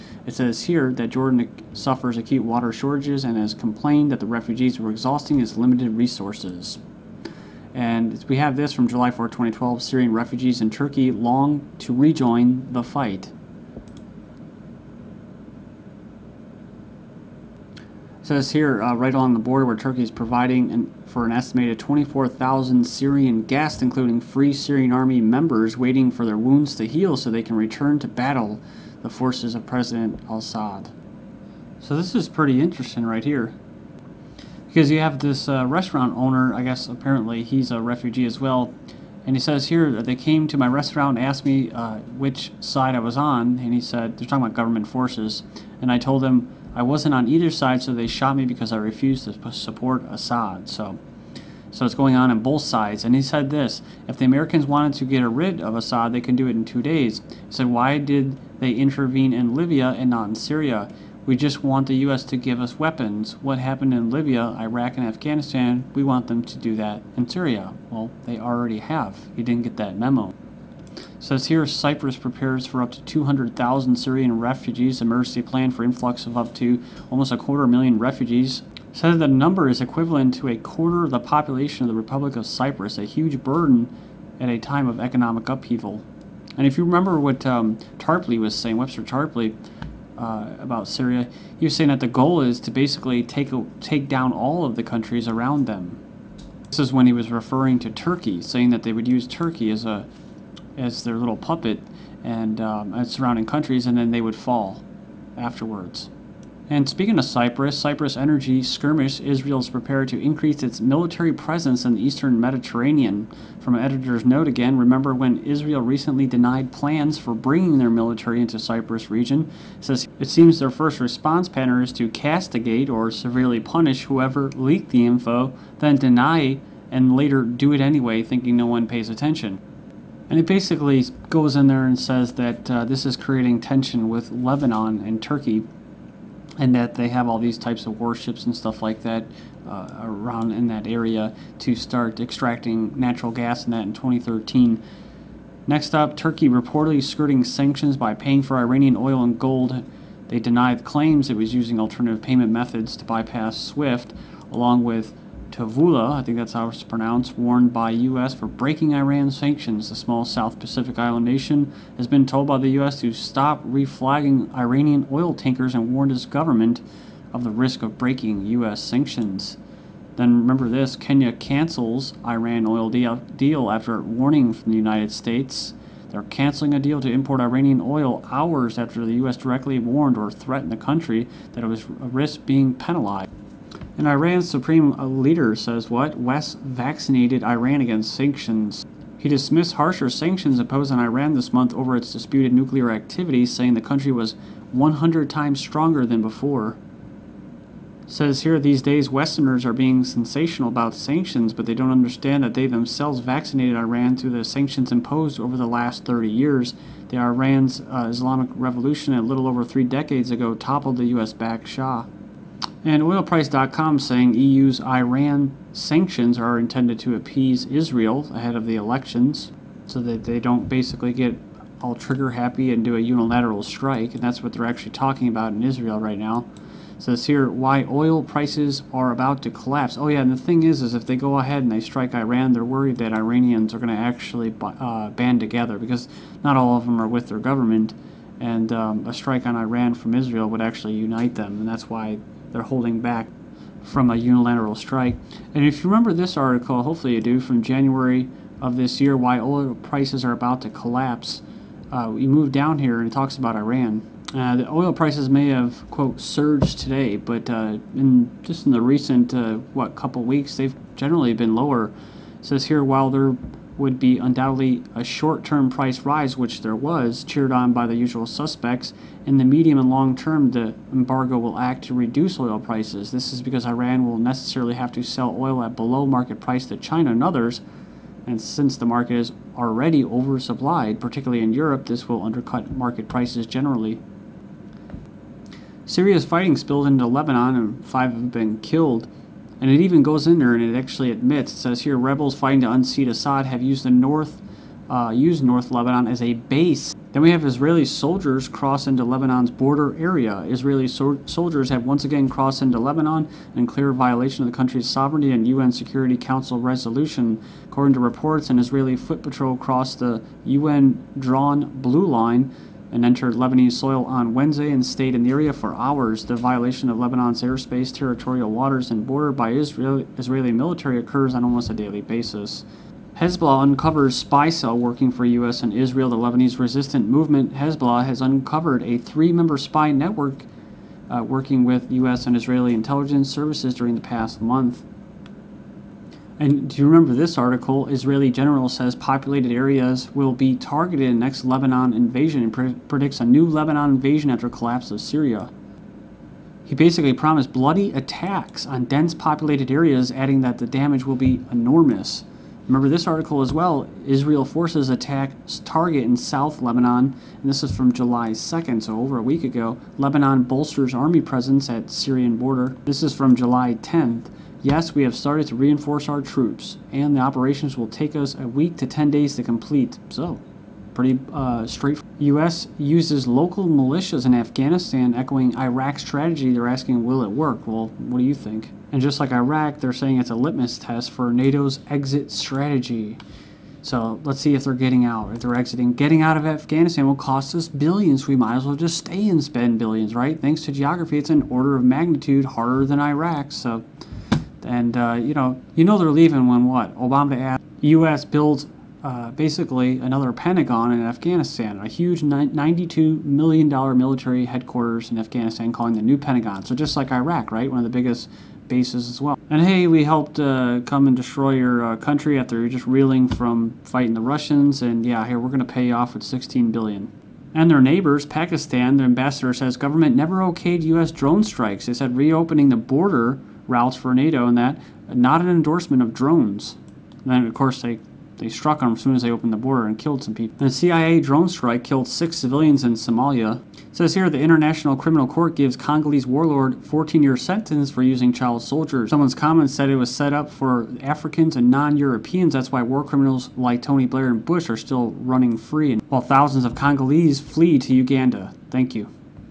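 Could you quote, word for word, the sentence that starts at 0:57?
He said, Why did they intervene in Libya and not in Syria?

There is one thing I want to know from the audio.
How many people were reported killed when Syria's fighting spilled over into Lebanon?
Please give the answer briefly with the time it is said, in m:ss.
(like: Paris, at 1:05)
5, at 4:47.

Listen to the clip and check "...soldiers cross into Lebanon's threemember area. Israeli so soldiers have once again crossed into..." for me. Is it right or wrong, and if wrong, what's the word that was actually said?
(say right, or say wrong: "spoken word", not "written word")
wrong: "border", not "threemember".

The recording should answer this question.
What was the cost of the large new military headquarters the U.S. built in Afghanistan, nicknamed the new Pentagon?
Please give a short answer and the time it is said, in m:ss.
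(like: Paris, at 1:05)
$92 million, at 6:42.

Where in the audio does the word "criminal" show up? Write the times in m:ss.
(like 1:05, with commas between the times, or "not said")
7:14, 7:23.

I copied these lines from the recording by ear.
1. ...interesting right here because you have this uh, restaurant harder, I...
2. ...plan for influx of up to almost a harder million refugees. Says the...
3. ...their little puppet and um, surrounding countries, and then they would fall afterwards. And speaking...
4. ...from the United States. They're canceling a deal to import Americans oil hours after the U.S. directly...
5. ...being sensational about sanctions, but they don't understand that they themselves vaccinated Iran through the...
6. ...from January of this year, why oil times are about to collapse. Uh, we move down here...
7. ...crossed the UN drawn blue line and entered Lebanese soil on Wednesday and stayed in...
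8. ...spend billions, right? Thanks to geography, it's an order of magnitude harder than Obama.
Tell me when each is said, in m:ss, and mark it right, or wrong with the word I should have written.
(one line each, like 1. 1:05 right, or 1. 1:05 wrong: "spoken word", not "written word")
1. 0:32 wrong: "owner", not "harder"
2. 1:15 wrong: "quarter", not "harder"
3. 1:41 right
4. 2:54 wrong: "Iranian", not "Americans"
5. 3:19 right
6. 4:07 wrong: "prices", not "times"
7. 5:09 right
8. 6:29 wrong: "Iraq", not "Obama".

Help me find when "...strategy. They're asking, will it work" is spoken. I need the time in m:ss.
6:16.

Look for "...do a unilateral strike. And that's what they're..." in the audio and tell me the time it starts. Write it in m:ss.
3:42.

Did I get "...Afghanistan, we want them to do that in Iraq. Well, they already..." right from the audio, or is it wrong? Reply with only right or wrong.
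wrong.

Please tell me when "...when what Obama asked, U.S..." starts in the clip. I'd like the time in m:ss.
6:36.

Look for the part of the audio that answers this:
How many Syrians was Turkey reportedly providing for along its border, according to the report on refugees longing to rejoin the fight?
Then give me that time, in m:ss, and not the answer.
0:21.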